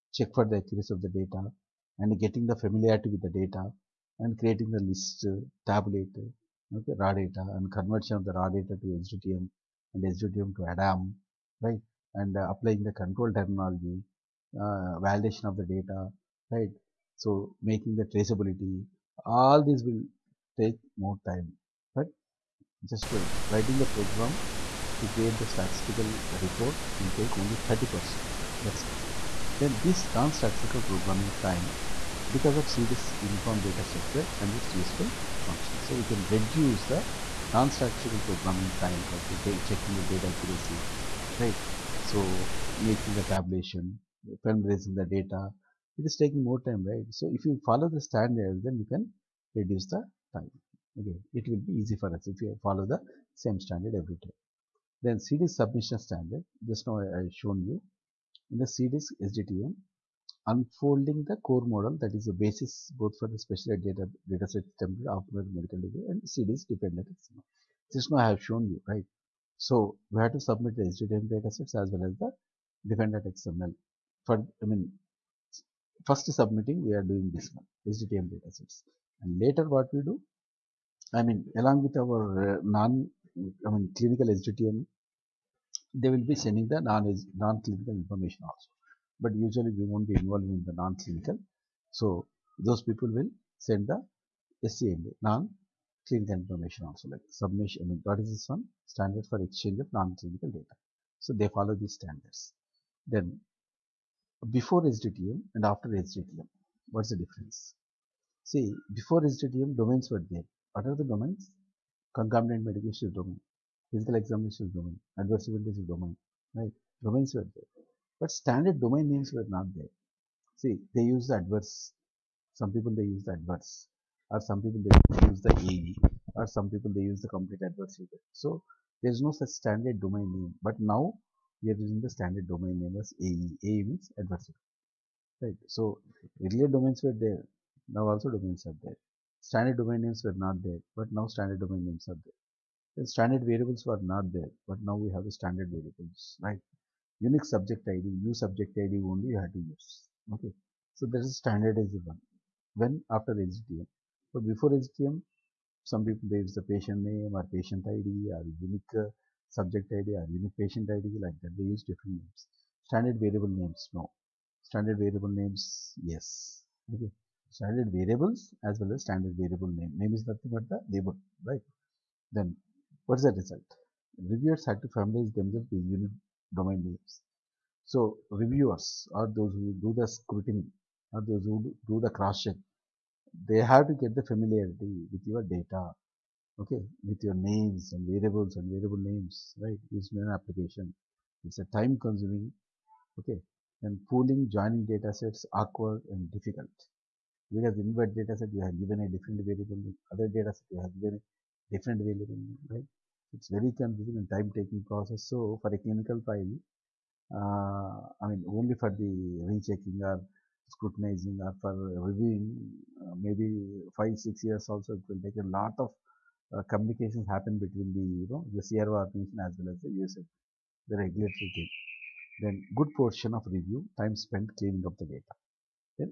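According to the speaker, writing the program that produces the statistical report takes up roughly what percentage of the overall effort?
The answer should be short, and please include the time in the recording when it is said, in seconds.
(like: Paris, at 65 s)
30%, at 27 s.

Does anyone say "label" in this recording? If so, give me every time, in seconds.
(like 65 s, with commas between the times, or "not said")
170 s.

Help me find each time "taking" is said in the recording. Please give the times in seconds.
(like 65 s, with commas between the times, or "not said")
46 s, 204 s.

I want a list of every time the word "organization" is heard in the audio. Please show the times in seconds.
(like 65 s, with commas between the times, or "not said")
219 s.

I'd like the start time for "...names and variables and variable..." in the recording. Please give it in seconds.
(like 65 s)
187 s.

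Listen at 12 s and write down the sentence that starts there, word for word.
And uh, applying the control terminology, uh, validation of the data, right?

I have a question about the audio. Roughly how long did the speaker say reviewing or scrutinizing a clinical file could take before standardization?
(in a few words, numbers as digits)
5-6 years.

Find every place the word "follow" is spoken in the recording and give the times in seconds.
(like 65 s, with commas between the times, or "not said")
47 s, 52 s, 101 s.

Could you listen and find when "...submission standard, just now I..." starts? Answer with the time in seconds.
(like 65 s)
55 s.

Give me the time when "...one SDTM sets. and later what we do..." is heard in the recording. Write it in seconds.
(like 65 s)
77 s.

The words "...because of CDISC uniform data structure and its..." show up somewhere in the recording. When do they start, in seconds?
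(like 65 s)
32 s.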